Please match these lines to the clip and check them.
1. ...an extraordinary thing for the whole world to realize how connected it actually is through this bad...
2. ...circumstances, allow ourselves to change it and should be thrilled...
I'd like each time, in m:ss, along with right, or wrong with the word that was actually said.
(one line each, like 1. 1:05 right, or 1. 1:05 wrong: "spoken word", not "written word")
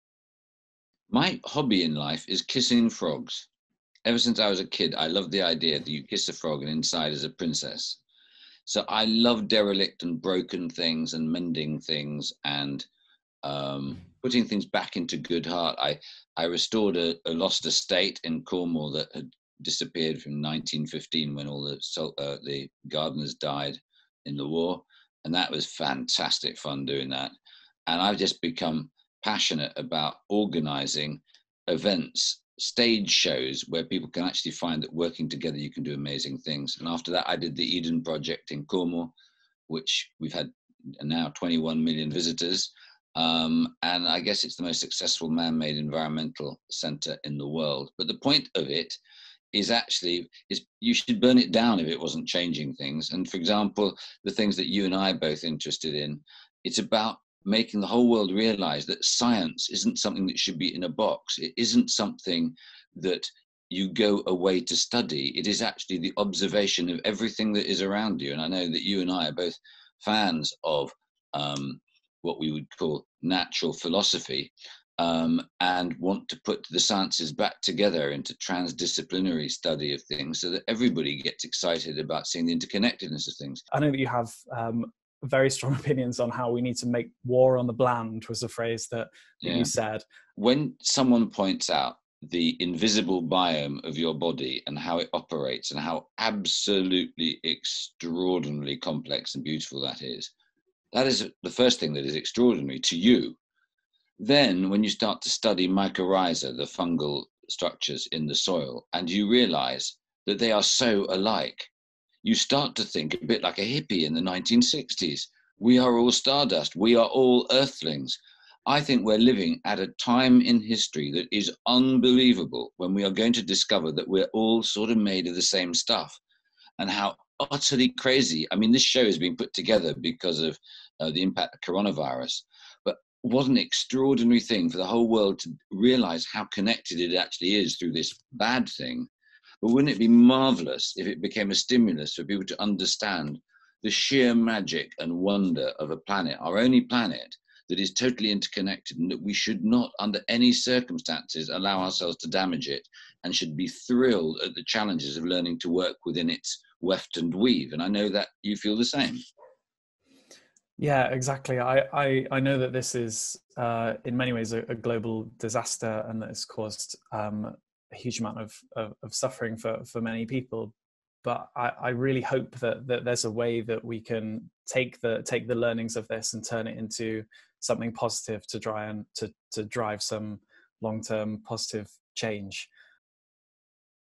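1. 2:13 right
2. 2:30 wrong: "damage", not "change".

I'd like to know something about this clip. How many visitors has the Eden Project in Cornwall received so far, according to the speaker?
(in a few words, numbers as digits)
21 million.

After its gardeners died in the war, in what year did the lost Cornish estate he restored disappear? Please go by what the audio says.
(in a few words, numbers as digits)
1915.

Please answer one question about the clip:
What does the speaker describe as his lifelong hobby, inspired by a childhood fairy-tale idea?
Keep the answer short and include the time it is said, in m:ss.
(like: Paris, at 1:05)
Kissing frogs, at 0:02.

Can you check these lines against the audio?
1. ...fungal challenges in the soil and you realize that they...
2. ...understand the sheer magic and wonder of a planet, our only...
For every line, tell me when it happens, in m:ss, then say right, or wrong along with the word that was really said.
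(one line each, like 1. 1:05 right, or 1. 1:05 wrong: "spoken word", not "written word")
1. 1:46 wrong: "structures", not "challenges"
2. 2:22 right.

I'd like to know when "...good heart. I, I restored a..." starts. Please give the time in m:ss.
0:15.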